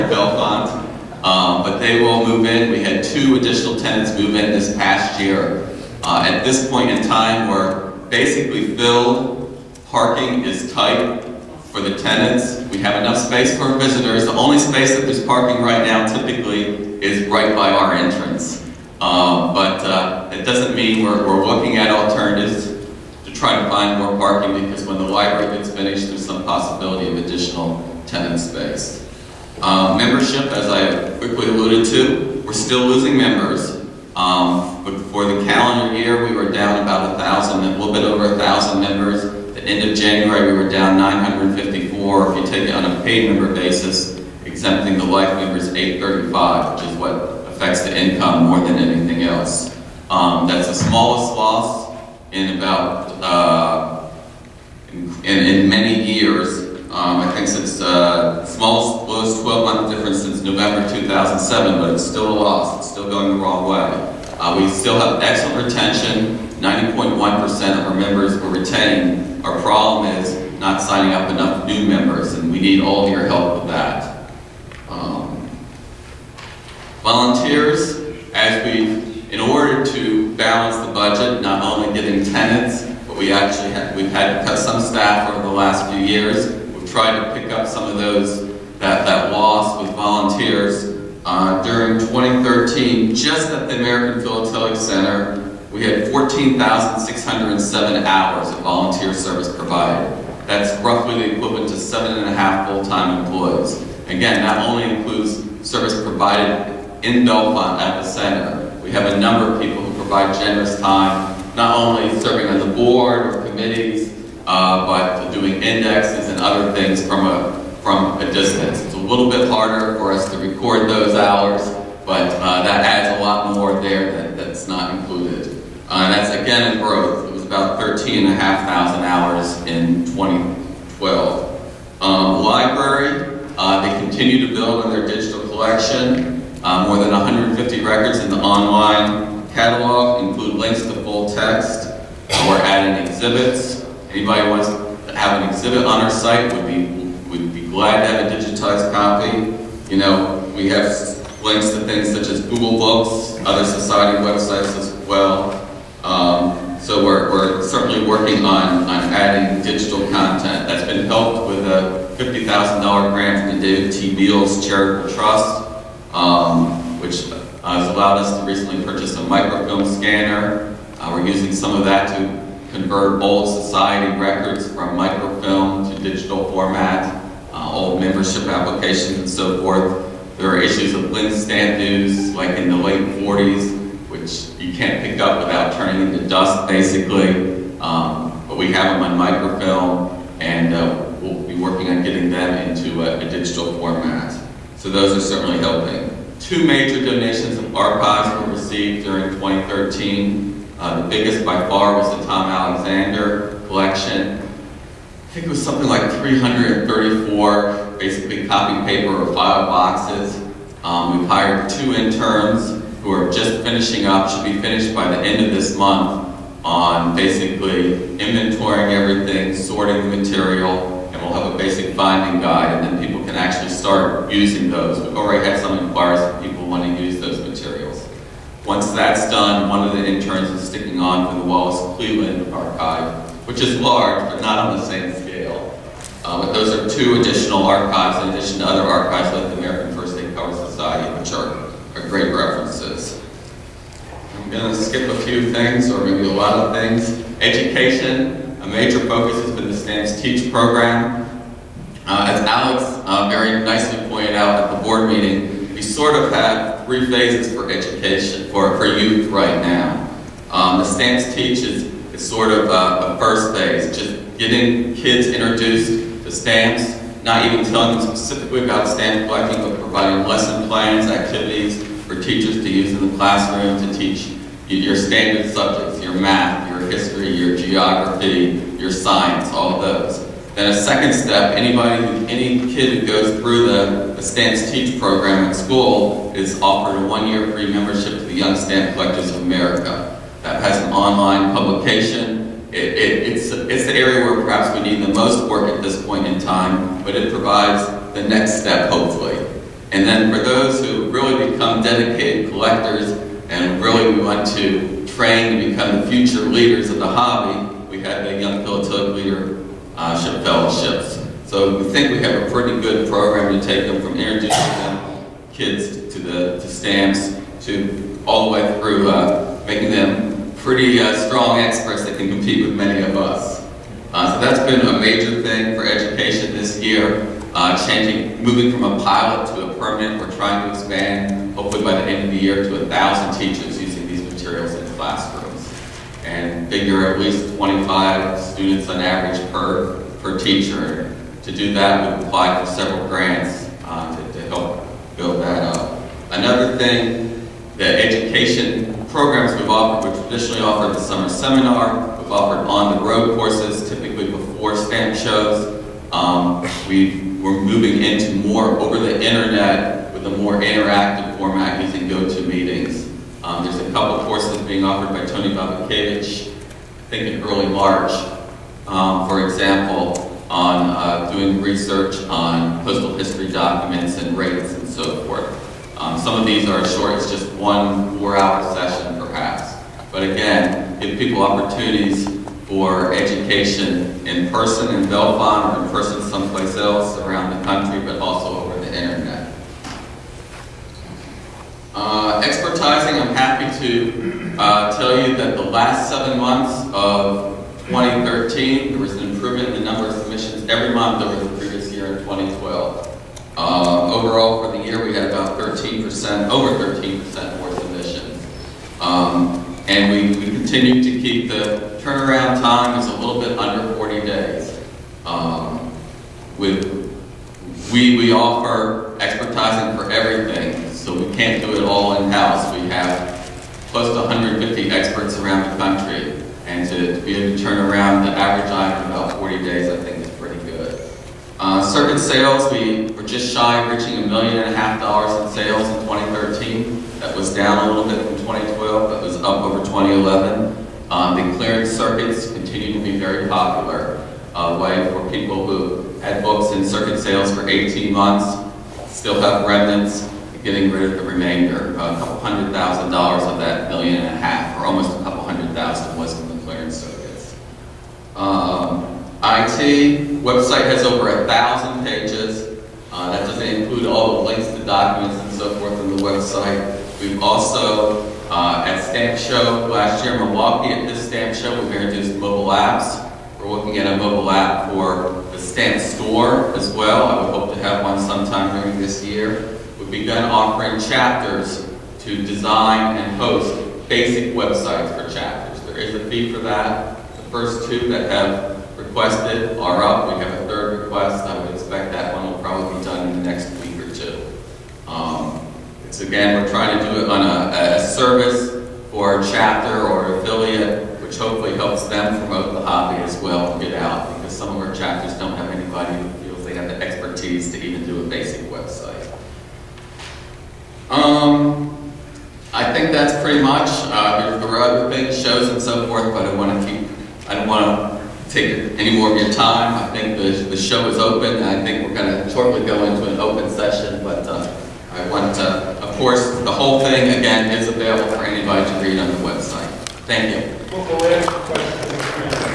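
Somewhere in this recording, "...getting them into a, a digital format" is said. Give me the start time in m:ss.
3:12.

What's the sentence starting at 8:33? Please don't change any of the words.
Uh, there were other things, shows and so forth, but I want to keep.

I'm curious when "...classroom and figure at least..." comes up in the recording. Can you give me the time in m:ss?
5:34.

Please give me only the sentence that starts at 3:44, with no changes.
We've already had some inquiries of people wanting to use those materials.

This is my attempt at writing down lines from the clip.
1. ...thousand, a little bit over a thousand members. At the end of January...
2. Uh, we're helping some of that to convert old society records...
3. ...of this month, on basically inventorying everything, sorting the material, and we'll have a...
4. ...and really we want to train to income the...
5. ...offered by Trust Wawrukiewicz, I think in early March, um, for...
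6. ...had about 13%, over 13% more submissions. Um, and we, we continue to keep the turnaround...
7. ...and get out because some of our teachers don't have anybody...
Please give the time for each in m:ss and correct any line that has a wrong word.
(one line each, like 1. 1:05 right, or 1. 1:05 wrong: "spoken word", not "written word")
1. 0:37 right
2. 2:50 wrong: "using", not "helping"
3. 3:35 right
4. 5:03 wrong: "become", not "income"
5. 6:04 wrong: "Tony", not "Trust"
6. 6:45 right
7. 8:23 wrong: "chapters", not "teachers".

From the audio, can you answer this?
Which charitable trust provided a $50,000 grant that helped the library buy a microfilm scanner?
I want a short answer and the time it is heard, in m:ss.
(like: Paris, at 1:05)
David T. Beals Charitable Trust, at 2:43.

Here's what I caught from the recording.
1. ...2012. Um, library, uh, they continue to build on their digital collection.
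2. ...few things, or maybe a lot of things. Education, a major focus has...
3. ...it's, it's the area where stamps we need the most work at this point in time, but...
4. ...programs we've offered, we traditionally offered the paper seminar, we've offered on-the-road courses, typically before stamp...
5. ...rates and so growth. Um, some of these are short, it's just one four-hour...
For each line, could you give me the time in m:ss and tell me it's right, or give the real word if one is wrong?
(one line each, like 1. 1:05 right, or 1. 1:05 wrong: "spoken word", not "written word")
1. 2:10 right
2. 4:05 right
3. 4:53 wrong: "perhaps", not "stamps"
4. 5:49 wrong: "summer", not "paper"
5. 6:14 wrong: "forth", not "growth".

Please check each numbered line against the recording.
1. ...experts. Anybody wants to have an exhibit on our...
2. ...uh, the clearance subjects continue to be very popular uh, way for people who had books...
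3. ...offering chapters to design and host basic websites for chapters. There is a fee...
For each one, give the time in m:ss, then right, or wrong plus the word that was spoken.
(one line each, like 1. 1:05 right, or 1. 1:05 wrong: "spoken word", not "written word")
1. 2:23 wrong: "exhibits", not "experts"
2. 7:21 wrong: "circuits", not "subjects"
3. 8:00 right.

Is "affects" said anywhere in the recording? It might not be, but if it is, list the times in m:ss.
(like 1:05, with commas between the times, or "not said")
0:47.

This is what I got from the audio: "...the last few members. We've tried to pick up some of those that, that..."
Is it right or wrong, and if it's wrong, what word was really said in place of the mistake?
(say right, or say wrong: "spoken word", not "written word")
wrong: "years", not "members".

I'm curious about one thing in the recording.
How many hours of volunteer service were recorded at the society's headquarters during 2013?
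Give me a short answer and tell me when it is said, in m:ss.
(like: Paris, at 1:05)
14,607, at 1:36.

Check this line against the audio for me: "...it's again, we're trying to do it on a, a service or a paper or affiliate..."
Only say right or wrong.
wrong.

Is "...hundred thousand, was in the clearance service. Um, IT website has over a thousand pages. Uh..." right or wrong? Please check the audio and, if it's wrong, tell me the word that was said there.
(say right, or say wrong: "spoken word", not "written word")
right.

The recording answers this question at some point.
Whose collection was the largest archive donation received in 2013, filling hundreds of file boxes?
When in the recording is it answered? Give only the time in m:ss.
3:22.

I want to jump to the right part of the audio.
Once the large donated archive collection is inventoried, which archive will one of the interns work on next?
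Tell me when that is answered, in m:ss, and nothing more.
3:51.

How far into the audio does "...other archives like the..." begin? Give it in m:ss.
3:58.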